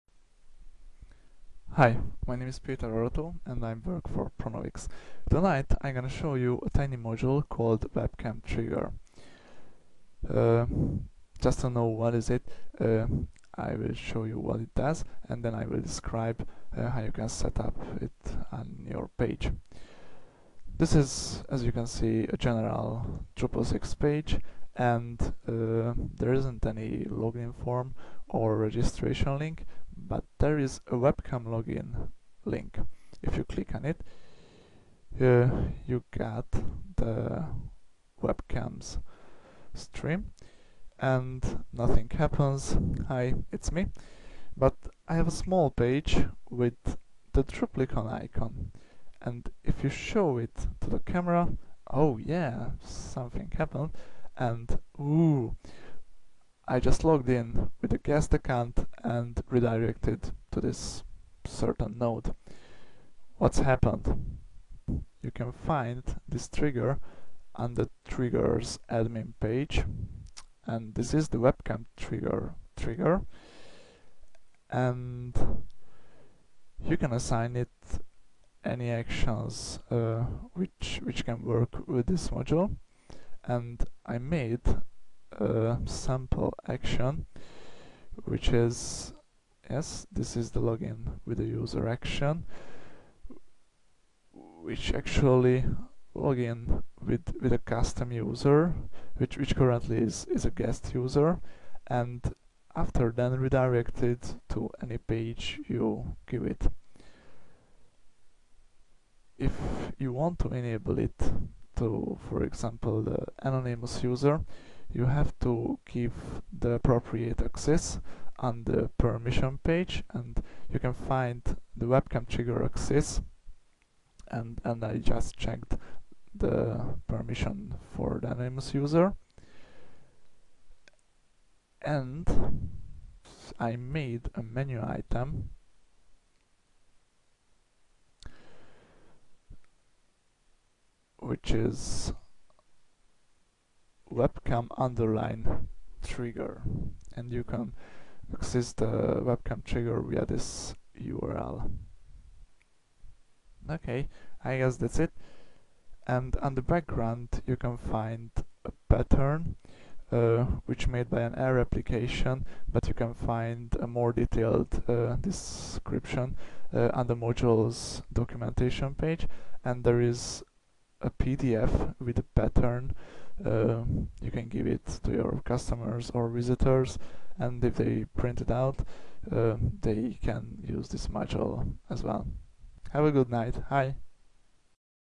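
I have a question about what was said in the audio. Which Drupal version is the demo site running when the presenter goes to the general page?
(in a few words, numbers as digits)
6.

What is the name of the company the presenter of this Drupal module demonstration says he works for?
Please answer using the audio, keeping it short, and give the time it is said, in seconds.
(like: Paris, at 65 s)
Pronovix, at 4 s.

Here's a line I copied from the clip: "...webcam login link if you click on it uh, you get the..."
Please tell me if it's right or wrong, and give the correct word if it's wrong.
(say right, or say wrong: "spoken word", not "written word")
right.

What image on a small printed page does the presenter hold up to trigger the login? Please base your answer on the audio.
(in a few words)
Druplicon icon.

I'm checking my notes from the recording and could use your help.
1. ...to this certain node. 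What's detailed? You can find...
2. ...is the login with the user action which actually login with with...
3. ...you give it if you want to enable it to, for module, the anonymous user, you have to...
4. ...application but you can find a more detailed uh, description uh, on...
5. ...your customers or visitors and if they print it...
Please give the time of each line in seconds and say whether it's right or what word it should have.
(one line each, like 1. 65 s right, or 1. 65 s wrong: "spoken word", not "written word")
1. 60 s wrong: "happened", not "detailed"
2. 90 s right
3. 105 s wrong: "example", not "module"
4. 161 s right
5. 175 s right.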